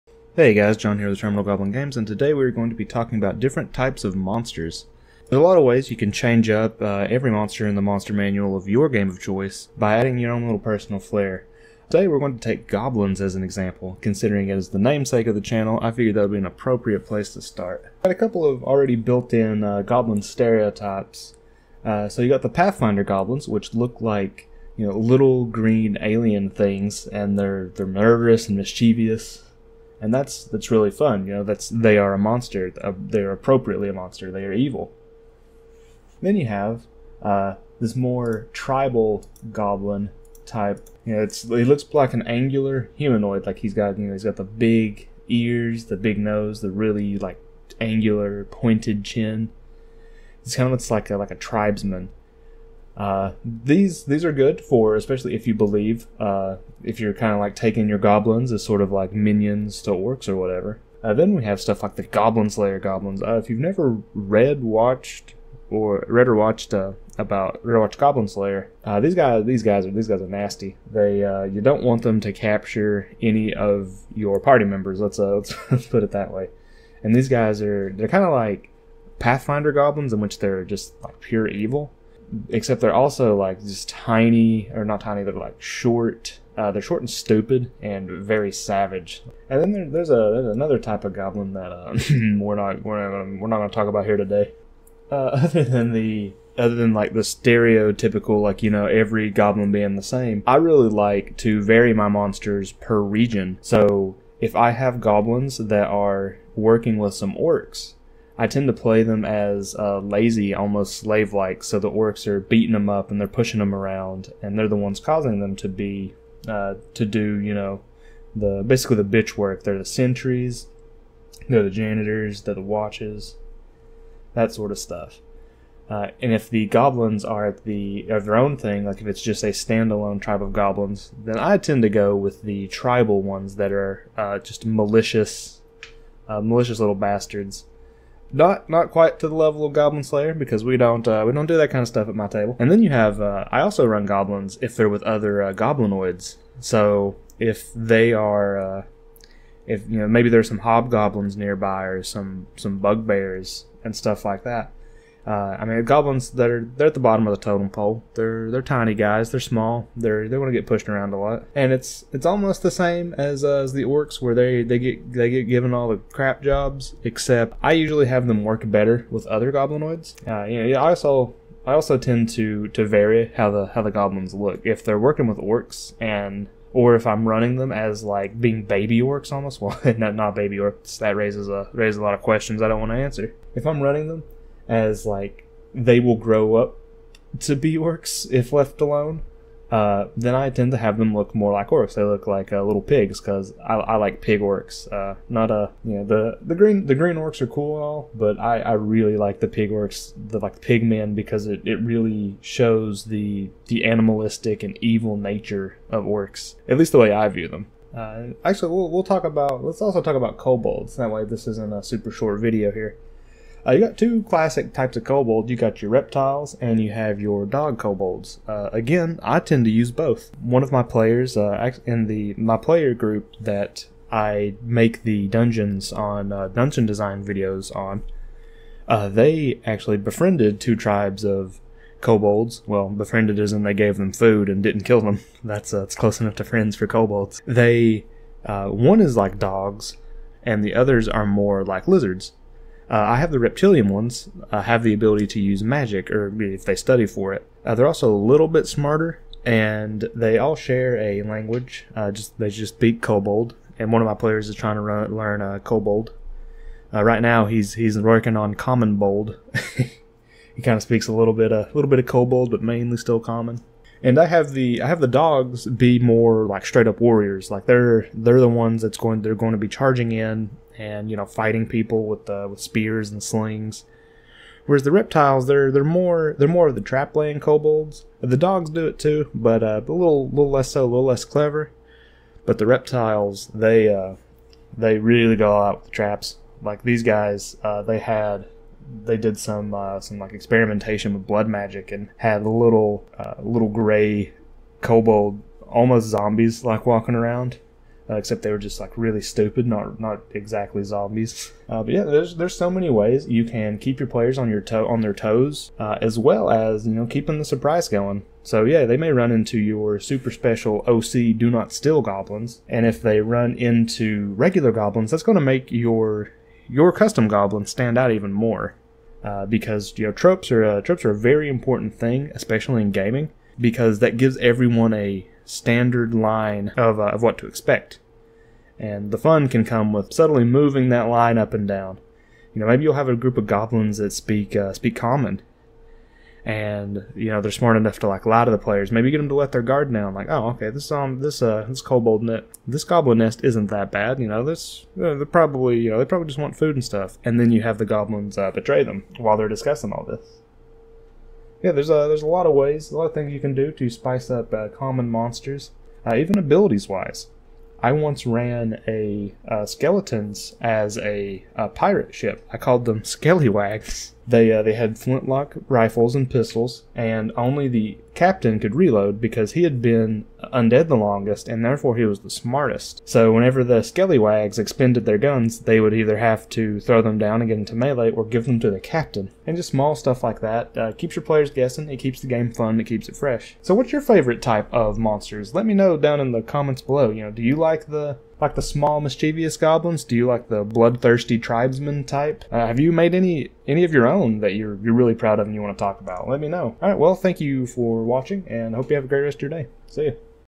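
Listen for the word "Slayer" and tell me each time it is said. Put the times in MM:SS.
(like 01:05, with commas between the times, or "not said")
01:02, 01:08, 02:20.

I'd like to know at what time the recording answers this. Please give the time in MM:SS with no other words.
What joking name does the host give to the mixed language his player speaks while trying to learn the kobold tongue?
04:18.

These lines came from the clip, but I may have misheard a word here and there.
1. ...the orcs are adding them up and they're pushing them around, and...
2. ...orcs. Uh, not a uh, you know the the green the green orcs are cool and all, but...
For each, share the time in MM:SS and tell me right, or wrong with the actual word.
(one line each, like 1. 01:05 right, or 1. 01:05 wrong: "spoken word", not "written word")
1. 01:51 wrong: "beating", not "adding"
2. 03:14 right.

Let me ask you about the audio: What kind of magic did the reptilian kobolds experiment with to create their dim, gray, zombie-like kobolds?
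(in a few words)
Blood magic.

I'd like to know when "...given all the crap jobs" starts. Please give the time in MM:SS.
02:45.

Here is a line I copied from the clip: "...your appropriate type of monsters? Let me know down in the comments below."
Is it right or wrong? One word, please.
wrong.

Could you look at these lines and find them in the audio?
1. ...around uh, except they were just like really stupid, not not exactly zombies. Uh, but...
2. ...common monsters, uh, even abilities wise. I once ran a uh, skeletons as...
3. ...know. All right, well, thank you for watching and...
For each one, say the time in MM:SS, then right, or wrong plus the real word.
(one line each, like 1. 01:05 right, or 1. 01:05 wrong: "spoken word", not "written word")
1. 04:57 right
2. 05:54 right
3. 06:36 right.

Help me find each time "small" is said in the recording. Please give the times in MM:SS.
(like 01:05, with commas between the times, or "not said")
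02:39, 06:19, 06:28.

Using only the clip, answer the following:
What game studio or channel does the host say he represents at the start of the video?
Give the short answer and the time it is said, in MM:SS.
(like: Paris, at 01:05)
Terminal Goblin Games, at 00:01.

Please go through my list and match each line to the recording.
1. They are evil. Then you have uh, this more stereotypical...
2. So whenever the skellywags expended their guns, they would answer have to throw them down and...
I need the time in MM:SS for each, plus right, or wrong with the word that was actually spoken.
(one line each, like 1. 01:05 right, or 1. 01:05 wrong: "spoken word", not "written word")
1. 00:34 wrong: "tribal", not "stereotypical"
2. 06:13 wrong: "either", not "answer".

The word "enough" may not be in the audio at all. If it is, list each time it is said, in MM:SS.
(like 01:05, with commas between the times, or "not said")
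03:56, 05:37.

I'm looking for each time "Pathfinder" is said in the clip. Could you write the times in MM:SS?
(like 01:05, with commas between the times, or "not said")
00:22, 01:19.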